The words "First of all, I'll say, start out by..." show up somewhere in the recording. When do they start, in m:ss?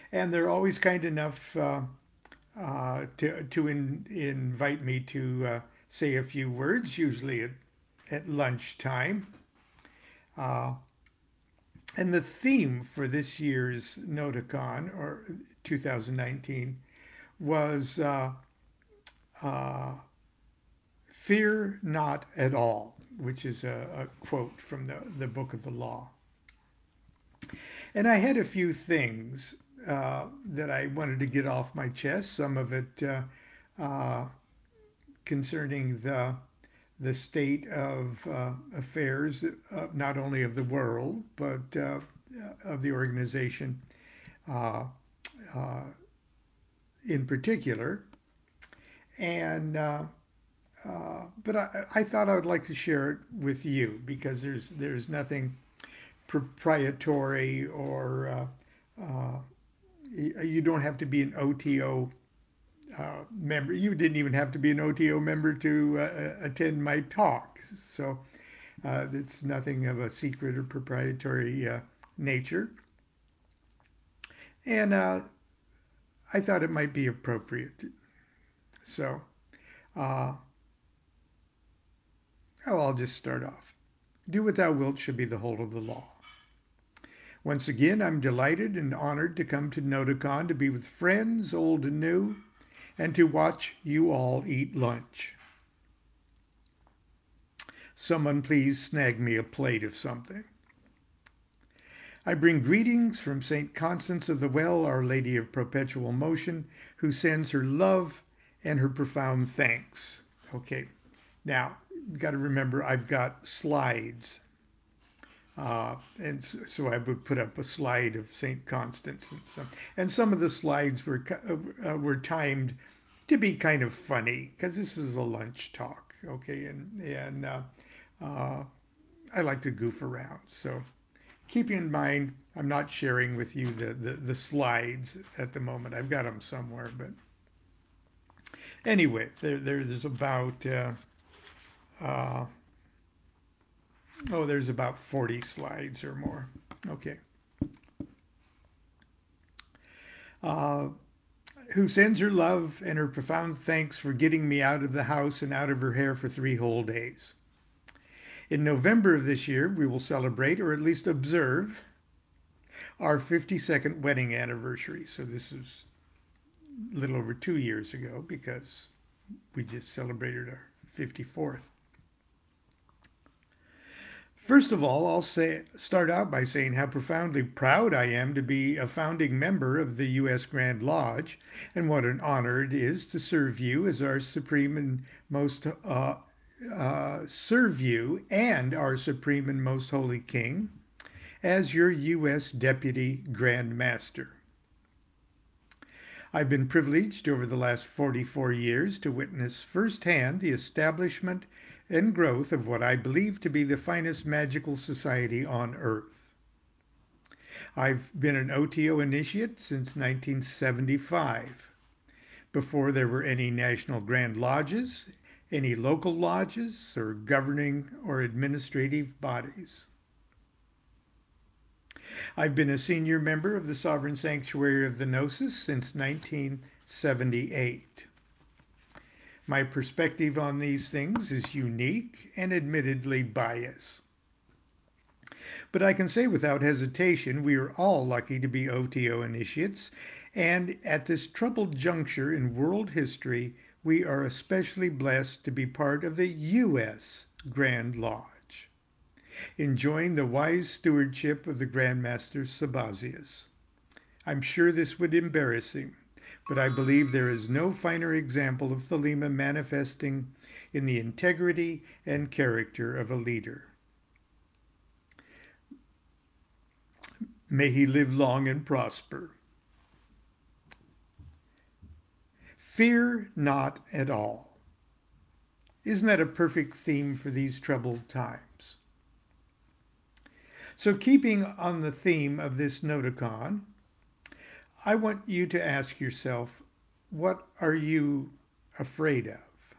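2:54.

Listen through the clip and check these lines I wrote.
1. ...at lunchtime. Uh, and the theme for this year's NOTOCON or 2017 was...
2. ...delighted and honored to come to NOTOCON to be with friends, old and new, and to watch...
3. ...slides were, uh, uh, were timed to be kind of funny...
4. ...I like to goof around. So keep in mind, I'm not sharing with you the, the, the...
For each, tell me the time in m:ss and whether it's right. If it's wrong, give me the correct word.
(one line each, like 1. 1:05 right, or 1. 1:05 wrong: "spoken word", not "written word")
1. 0:08 wrong: "2019", not "2017"
2. 1:28 right
3. 2:00 right
4. 2:09 right.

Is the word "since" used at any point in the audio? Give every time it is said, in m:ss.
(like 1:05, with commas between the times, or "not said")
3:29, 3:45.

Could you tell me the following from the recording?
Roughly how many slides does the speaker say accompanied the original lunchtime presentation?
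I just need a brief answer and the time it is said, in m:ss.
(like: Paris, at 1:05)
40, at 2:24.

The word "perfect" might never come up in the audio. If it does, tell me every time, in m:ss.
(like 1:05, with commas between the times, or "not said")
4:36.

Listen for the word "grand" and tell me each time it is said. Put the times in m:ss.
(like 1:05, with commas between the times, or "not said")
3:00, 3:13, 3:33, 4:07, 4:11.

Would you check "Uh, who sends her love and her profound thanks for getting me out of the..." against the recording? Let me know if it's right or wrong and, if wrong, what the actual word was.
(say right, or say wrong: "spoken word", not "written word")
right.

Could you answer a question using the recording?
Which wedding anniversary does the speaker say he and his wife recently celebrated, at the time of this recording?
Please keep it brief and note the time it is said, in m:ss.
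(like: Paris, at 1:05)
54th, at 2:50.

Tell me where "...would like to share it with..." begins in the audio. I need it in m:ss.
0:52.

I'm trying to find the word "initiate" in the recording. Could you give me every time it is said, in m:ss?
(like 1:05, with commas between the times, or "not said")
3:29, 3:59.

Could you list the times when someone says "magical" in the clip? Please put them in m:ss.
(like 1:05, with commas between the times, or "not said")
3:24.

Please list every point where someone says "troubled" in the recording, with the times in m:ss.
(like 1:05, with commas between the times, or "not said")
4:01, 4:37.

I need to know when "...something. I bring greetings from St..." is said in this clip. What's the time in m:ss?
1:39.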